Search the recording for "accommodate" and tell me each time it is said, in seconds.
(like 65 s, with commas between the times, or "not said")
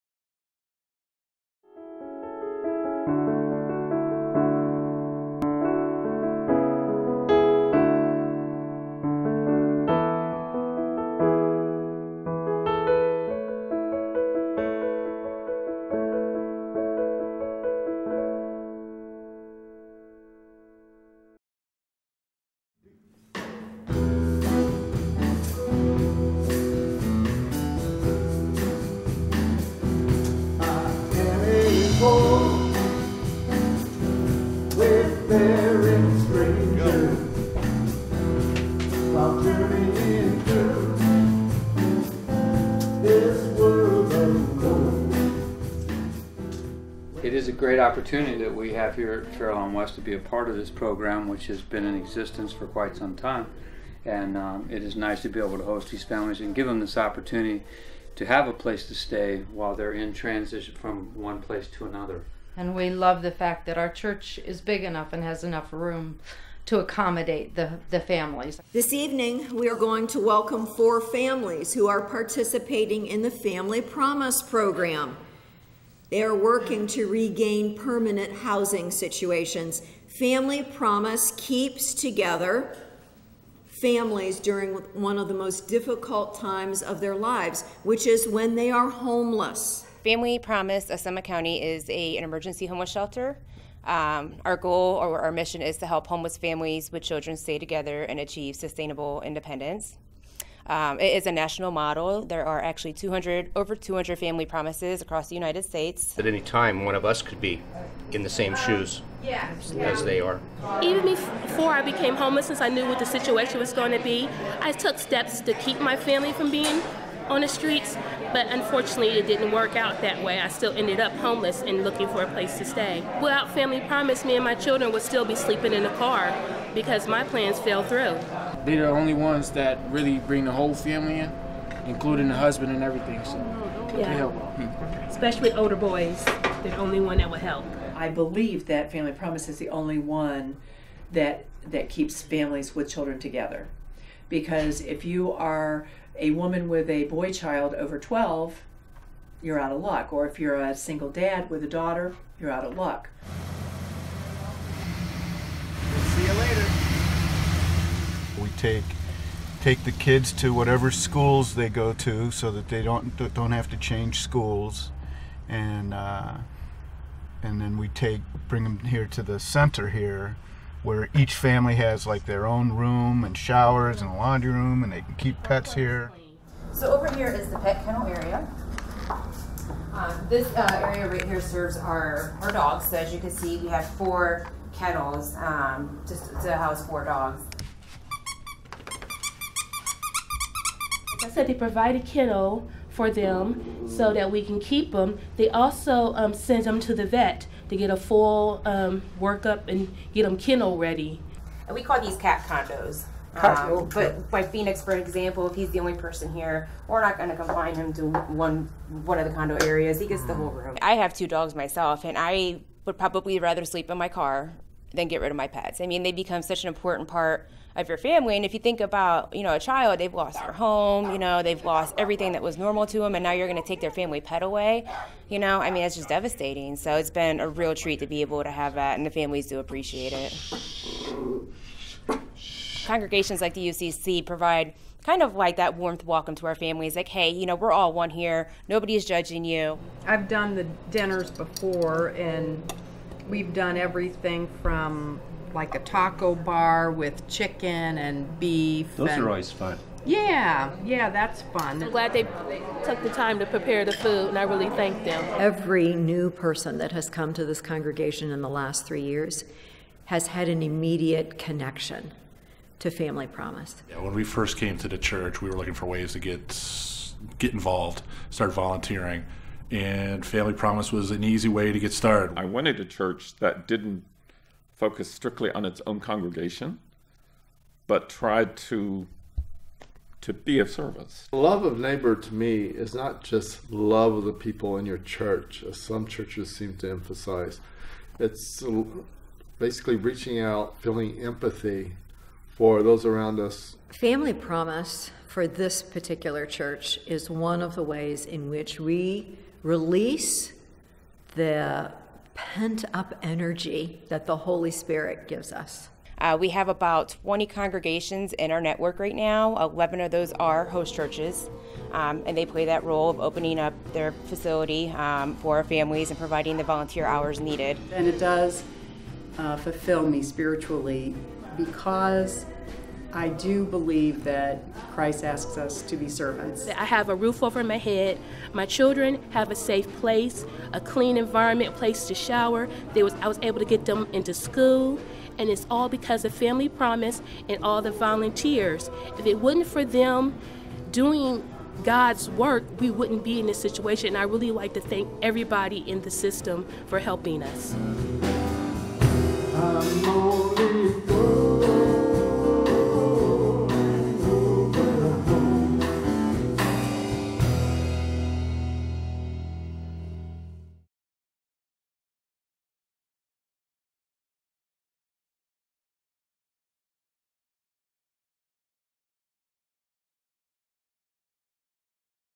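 66 s.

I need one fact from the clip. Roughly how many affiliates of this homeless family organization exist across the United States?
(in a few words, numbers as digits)
over 200.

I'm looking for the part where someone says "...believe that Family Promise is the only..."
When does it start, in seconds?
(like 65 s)
138 s.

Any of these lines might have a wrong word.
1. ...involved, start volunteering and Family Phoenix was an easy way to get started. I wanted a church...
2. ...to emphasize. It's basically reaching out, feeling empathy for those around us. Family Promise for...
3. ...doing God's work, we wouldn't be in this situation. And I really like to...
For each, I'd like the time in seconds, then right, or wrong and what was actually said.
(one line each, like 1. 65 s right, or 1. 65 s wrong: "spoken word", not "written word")
1. 267 s wrong: "Promise", not "Phoenix"
2. 286 s right
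3. 340 s right.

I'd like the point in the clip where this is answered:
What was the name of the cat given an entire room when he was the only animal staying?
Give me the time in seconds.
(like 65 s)
204 s.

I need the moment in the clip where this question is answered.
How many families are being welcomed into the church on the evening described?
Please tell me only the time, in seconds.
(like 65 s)
70 s.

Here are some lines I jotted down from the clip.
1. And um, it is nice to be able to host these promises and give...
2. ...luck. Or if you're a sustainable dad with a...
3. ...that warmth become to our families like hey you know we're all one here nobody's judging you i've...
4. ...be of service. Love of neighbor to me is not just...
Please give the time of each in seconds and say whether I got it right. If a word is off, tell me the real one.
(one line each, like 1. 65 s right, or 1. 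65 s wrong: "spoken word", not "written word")
1. 54 s wrong: "families", not "promises"
2. 149 s wrong: "single", not "sustainable"
3. 235 s wrong: "welcome", not "become"
4. 280 s right.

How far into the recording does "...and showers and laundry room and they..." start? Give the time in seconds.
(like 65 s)
173 s.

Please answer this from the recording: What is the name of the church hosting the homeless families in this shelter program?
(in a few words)
Fairlawn West.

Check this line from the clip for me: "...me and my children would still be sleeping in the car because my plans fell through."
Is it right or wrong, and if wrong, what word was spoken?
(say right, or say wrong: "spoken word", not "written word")
right.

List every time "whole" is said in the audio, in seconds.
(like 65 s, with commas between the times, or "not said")
130 s, 210 s.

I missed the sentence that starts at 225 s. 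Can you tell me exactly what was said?
You know, I mean, it's just devastating.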